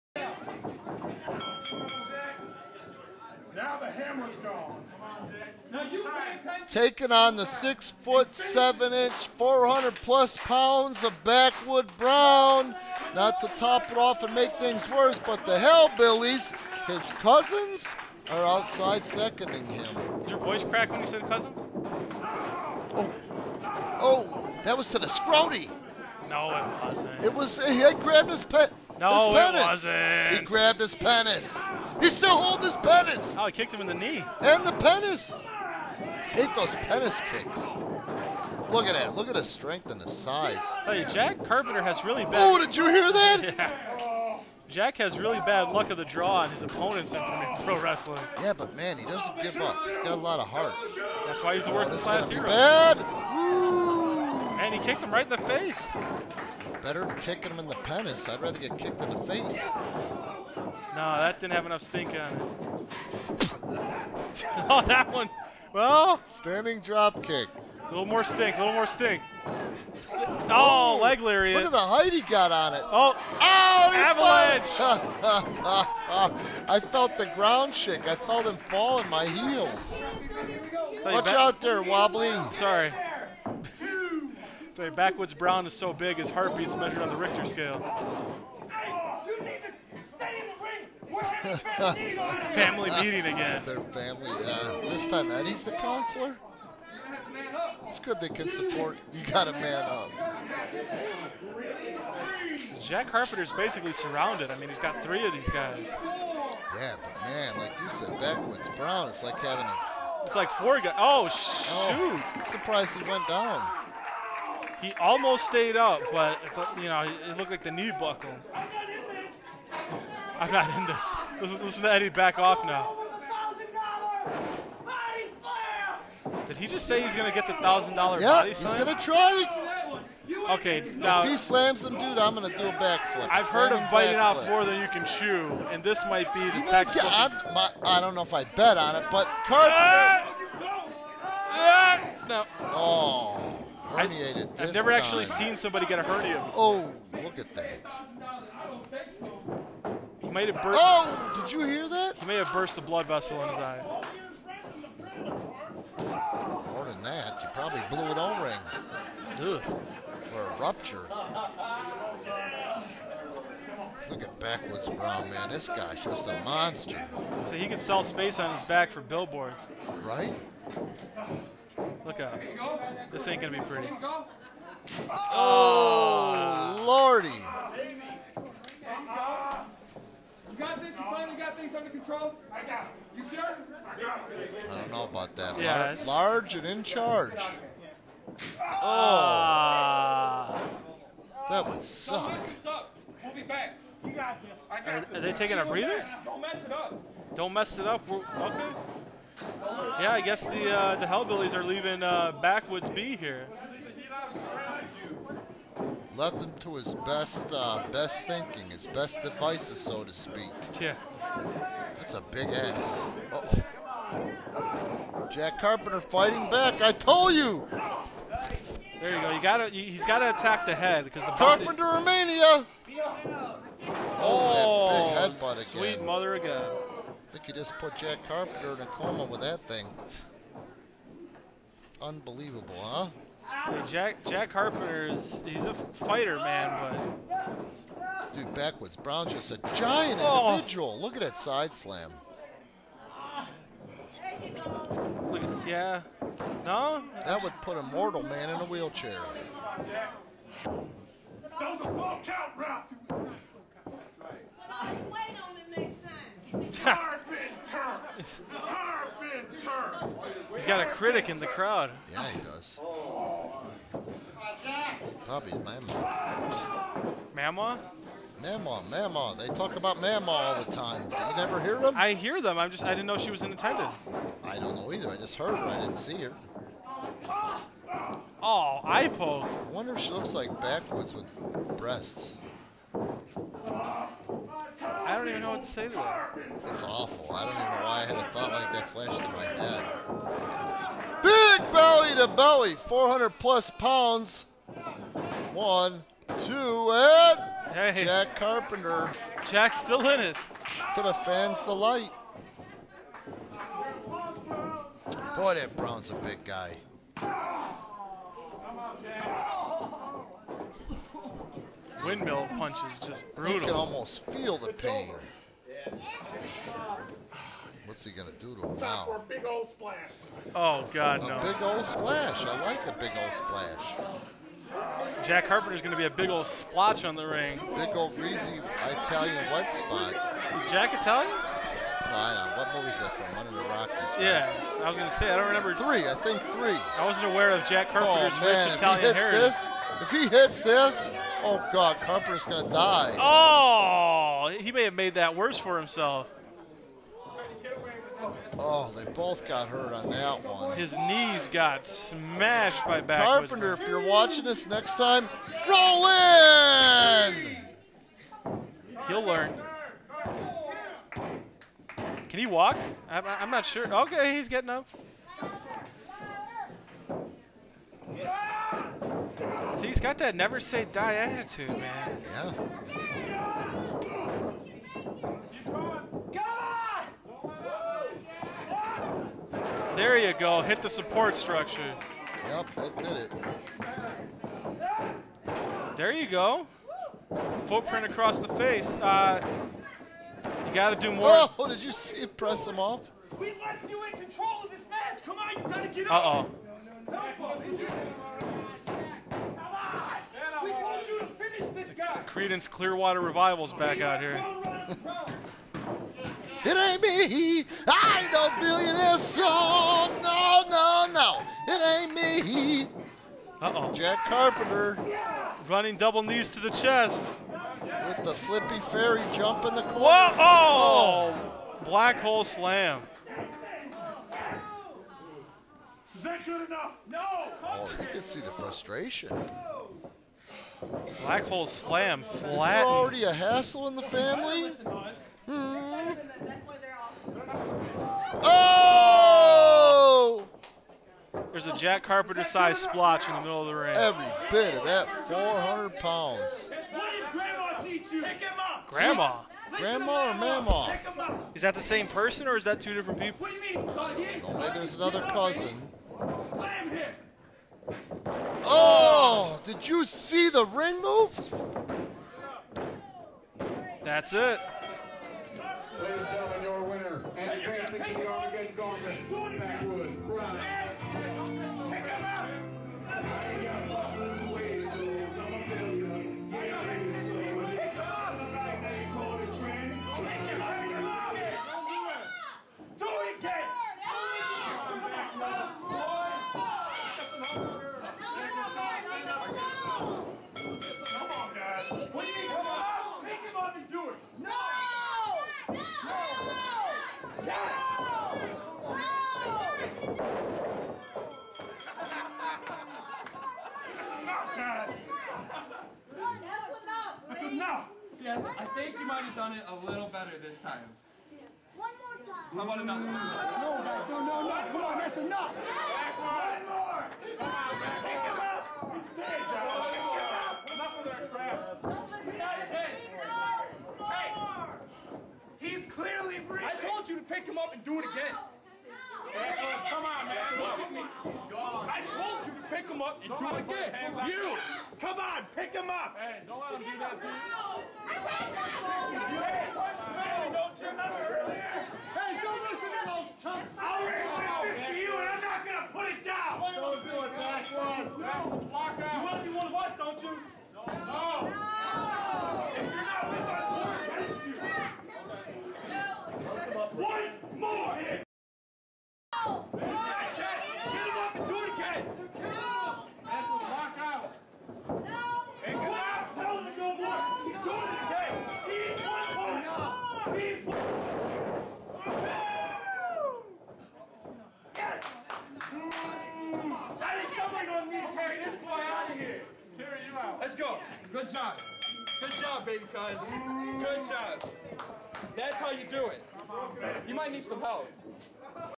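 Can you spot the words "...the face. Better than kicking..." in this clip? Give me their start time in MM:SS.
00:55.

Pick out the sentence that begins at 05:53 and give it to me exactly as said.
Carpenter, if you're watching this next time, roll in!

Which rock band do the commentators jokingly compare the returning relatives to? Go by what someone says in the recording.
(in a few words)
Creedence Clearwater Revival.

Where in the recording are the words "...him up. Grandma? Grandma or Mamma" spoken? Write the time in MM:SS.
07:28.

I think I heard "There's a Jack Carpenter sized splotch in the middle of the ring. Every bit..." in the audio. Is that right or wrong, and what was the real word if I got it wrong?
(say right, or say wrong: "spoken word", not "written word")
right.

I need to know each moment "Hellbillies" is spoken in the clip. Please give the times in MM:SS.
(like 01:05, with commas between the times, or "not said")
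00:15, 03:21.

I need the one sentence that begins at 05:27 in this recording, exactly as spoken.
Big old greasy Italian wet spot.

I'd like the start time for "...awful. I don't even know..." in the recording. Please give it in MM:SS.
04:46.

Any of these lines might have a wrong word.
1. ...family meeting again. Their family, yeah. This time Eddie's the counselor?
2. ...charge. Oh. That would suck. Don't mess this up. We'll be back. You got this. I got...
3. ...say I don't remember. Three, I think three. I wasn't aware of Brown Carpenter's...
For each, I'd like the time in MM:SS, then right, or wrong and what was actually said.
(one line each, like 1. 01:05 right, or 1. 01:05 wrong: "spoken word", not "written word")
1. 01:32 right
2. 03:06 right
3. 05:35 wrong: "Jack", not "Brown".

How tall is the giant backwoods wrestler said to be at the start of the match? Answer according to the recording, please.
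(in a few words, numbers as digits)
Six foot seven.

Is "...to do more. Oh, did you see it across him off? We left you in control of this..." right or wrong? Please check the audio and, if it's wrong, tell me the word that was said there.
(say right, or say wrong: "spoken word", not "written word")
wrong: "press", not "across".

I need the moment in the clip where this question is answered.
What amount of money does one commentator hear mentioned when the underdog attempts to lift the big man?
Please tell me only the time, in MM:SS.
02:07.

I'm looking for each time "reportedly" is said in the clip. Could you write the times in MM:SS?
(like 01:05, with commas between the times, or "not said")
not said.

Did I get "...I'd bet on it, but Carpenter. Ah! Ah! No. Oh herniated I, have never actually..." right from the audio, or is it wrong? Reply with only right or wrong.
right.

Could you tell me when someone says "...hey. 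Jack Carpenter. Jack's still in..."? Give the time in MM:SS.
04:57.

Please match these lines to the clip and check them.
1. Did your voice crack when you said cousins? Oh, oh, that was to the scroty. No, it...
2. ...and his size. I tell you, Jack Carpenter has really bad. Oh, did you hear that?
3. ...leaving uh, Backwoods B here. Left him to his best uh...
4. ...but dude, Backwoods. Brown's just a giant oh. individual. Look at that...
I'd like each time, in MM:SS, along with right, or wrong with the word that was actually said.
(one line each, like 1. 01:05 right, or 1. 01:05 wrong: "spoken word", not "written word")
1. 00:20 right
2. 00:39 right
3. 03:21 right
4. 03:57 right.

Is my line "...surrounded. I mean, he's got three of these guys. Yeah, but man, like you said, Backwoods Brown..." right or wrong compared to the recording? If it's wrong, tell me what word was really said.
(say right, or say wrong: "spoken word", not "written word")
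right.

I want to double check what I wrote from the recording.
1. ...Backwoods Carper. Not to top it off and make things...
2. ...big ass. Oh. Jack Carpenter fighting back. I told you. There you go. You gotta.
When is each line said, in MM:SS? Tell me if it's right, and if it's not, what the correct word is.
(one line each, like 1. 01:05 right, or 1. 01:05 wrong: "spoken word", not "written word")
1. 00:11 wrong: "Brown", not "Carper"
2. 03:32 right.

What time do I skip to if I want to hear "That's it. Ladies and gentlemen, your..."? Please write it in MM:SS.
07:44.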